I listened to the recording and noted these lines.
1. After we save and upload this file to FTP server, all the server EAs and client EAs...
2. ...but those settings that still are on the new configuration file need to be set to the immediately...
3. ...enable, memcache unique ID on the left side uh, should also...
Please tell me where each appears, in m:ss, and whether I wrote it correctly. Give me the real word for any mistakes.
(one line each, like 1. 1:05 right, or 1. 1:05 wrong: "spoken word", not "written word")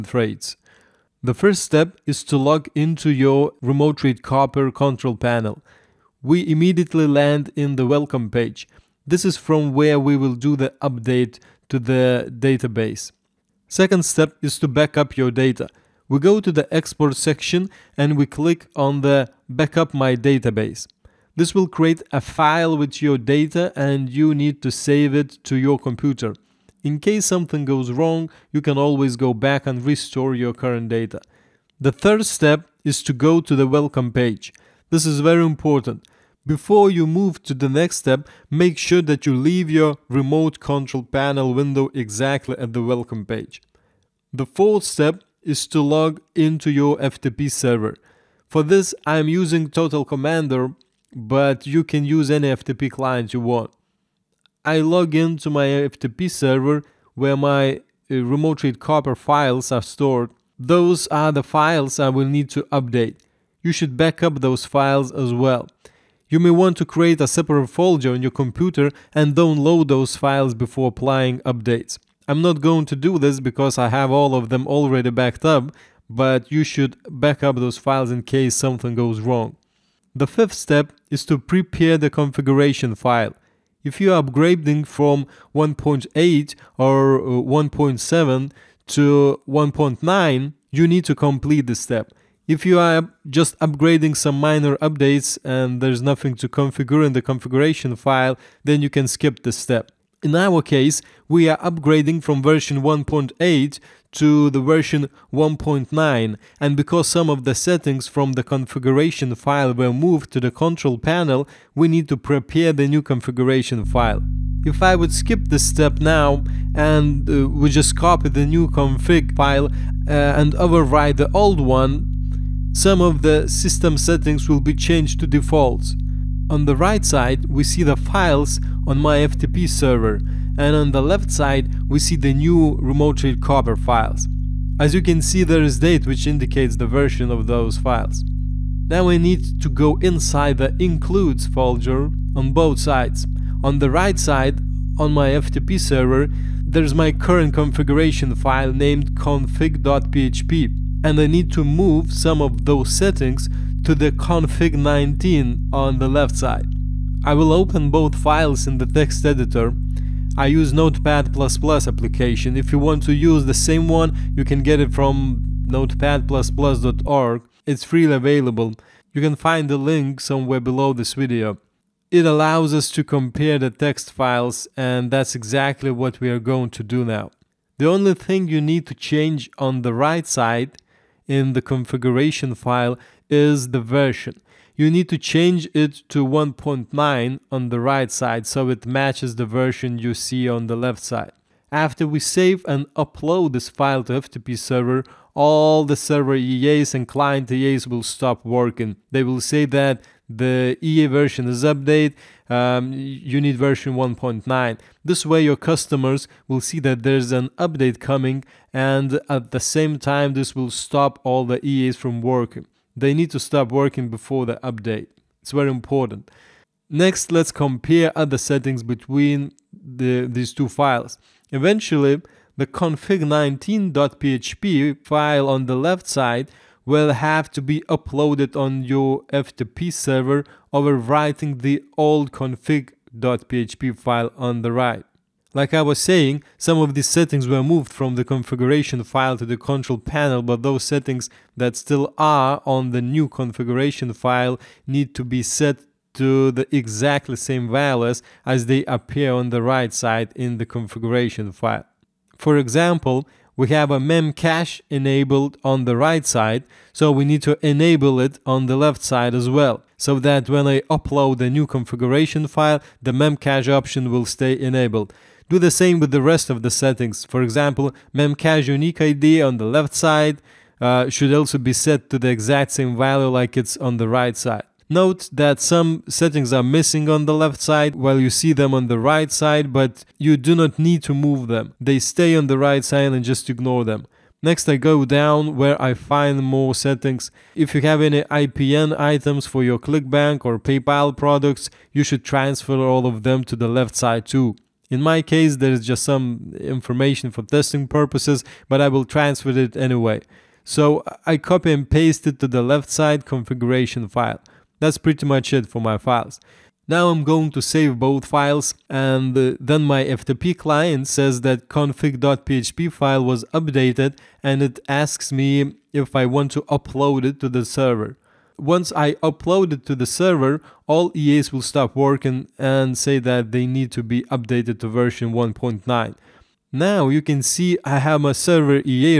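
1. 3:11 right
2. 4:00 wrong: "exactly", not "immediately"
3. 4:27 wrong: "example", not "enable".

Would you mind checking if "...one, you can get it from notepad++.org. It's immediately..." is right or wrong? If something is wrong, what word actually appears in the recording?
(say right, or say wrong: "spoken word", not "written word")
wrong: "freely", not "immediately".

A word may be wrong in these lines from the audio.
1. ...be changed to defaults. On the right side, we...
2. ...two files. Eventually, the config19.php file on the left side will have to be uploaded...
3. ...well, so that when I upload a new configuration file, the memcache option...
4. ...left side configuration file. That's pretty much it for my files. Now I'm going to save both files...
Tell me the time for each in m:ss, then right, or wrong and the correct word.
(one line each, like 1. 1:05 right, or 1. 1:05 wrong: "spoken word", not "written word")
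1. 2:04 right
2. 3:40 right
3. 4:19 right
4. 5:02 right.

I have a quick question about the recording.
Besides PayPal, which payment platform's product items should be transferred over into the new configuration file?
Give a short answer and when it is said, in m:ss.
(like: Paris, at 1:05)
ClickBank, at 4:49.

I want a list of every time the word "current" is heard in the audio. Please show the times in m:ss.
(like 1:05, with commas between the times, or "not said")
0:30, 2:27.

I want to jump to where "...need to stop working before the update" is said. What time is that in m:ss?
3:33.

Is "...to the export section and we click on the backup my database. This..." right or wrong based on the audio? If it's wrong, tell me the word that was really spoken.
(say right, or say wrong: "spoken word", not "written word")
right.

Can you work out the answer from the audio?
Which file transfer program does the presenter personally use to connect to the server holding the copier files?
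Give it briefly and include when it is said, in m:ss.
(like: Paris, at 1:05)
Total Commander, at 0:49.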